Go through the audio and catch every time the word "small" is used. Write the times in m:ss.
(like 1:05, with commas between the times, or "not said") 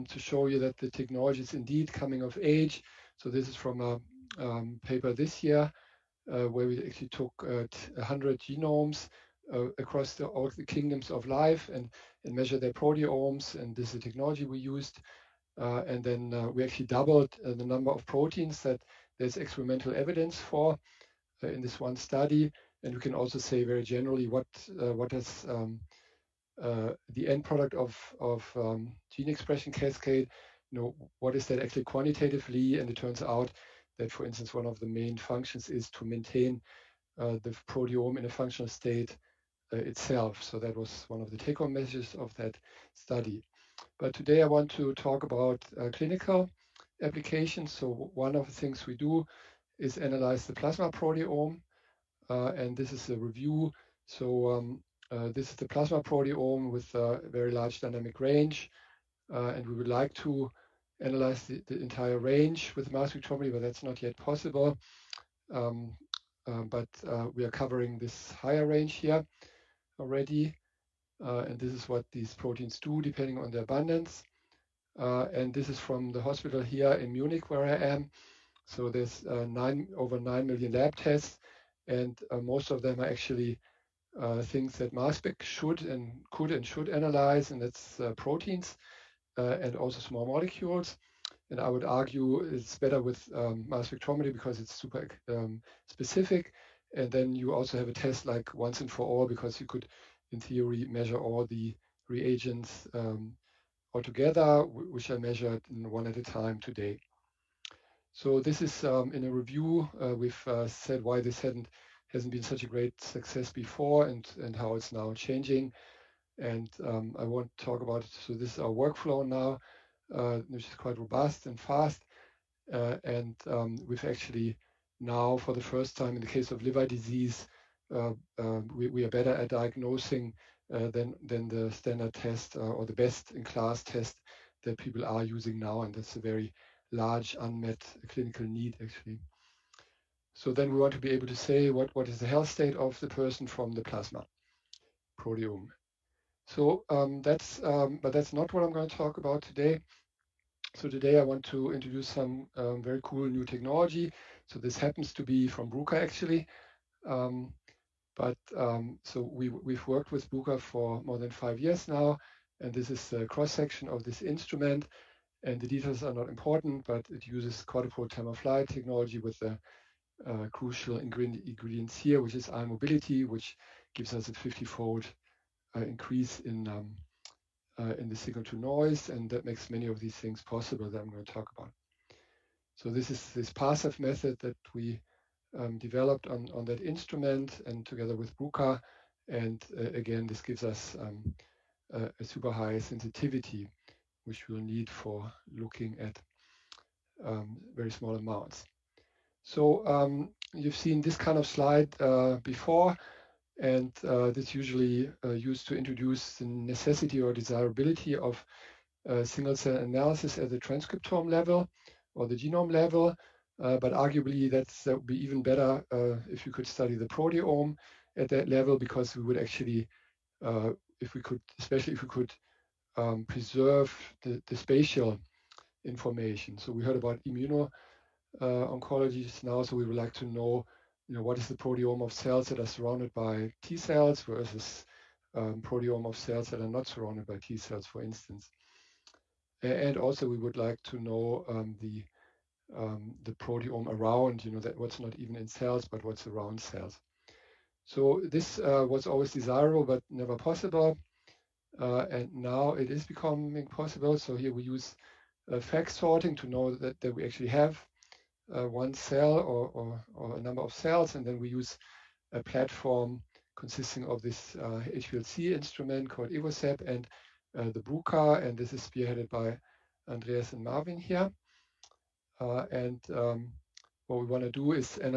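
1:30, 3:17.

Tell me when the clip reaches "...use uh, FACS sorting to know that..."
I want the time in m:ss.
4:14.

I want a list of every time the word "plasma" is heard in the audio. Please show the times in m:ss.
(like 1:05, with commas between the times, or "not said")
0:50, 0:55, 2:23.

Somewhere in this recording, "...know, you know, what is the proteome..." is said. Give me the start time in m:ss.
3:50.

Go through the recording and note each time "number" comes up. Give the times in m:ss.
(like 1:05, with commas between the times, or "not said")
0:17, 4:20.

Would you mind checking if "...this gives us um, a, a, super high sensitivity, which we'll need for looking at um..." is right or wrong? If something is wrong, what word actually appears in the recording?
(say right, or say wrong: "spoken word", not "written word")
right.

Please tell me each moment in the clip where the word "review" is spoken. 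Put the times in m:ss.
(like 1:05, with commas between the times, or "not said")
0:53, 1:49.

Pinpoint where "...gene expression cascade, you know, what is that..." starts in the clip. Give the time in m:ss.
0:29.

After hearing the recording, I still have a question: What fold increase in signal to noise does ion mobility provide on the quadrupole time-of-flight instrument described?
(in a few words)
50-fold.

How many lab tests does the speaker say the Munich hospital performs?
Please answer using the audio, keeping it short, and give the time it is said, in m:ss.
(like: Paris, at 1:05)
over 9 million, at 1:19.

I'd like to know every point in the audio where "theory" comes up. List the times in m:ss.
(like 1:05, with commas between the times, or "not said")
1:40.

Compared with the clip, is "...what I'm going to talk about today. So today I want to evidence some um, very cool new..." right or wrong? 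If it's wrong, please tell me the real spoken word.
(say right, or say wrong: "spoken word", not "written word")
wrong: "introduce", not "evidence".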